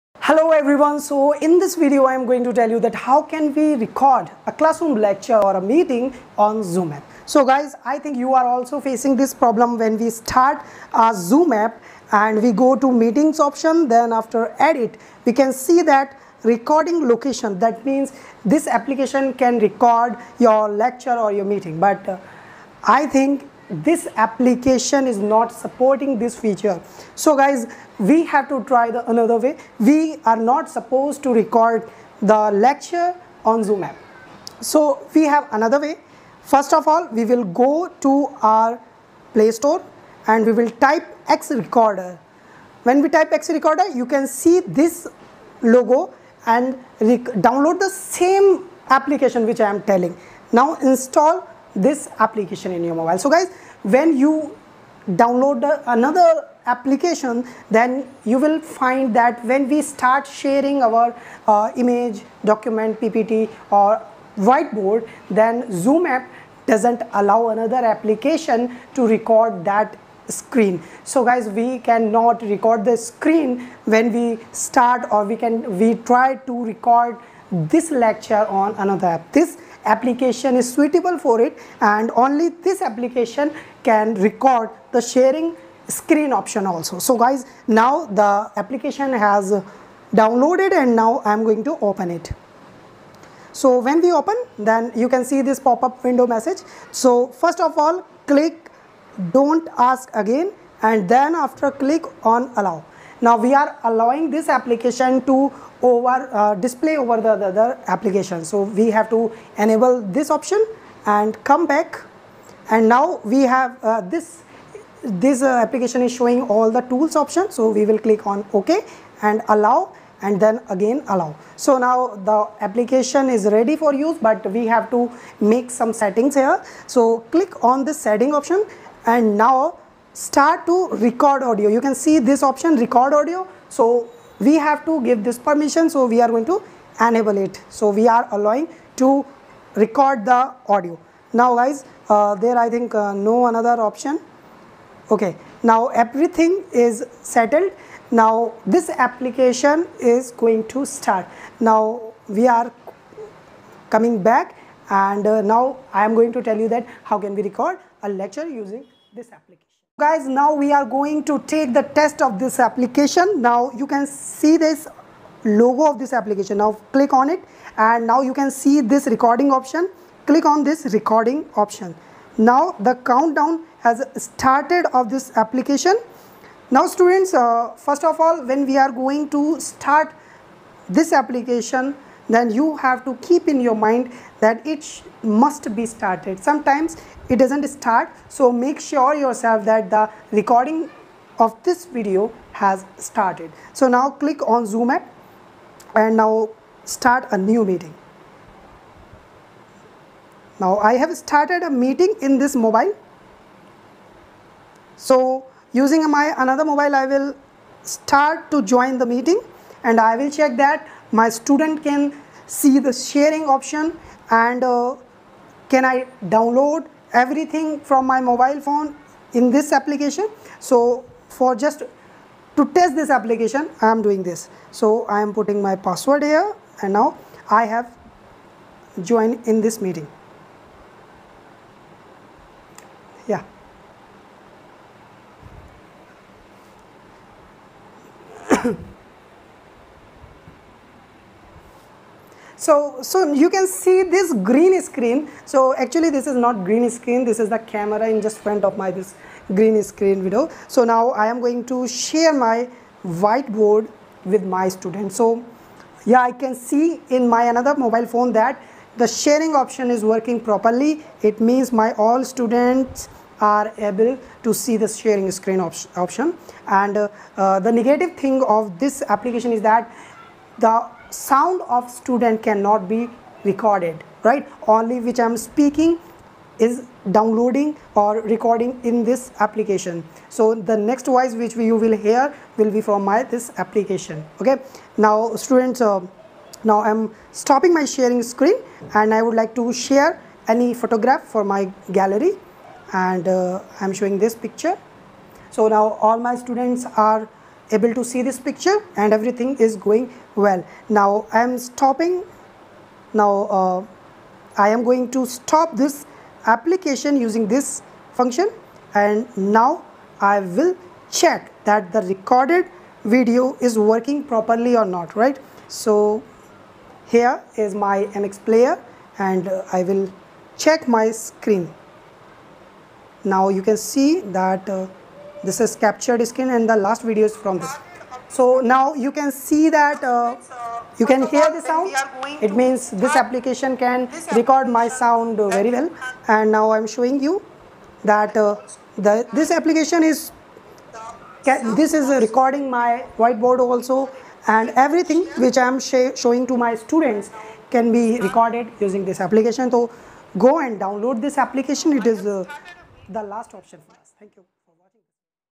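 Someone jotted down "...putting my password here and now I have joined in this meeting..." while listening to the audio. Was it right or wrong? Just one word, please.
right.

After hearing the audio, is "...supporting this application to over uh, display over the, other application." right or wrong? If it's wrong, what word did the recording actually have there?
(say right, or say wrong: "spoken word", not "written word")
wrong: "allowing", not "supporting".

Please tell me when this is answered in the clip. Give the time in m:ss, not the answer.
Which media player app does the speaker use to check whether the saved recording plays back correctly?
5:18.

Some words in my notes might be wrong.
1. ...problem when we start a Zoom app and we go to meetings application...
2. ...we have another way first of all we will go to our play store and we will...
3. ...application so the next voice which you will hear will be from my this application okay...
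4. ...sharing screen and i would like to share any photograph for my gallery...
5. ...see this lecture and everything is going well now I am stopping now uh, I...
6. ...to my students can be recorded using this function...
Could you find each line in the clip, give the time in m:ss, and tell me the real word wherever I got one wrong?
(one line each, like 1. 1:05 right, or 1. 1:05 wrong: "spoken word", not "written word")
1. 0:09 wrong: "option", not "application"
2. 0:35 right
3. 4:39 right
4. 4:47 right
5. 4:58 wrong: "picture", not "lecture"
6. 5:46 wrong: "application", not "function".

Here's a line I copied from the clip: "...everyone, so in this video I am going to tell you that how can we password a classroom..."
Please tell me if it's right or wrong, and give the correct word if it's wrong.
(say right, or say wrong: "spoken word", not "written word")
wrong: "record", not "password".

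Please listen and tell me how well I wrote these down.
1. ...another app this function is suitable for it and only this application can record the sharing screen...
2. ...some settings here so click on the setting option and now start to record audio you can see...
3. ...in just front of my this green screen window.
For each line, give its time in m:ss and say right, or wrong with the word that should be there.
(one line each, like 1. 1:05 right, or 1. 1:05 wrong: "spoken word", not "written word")
1. 1:18 wrong: "application", not "function"
2. 2:05 right
3. 4:08 right.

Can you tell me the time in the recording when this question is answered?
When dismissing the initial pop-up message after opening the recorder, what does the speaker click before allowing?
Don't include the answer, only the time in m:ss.
1:39.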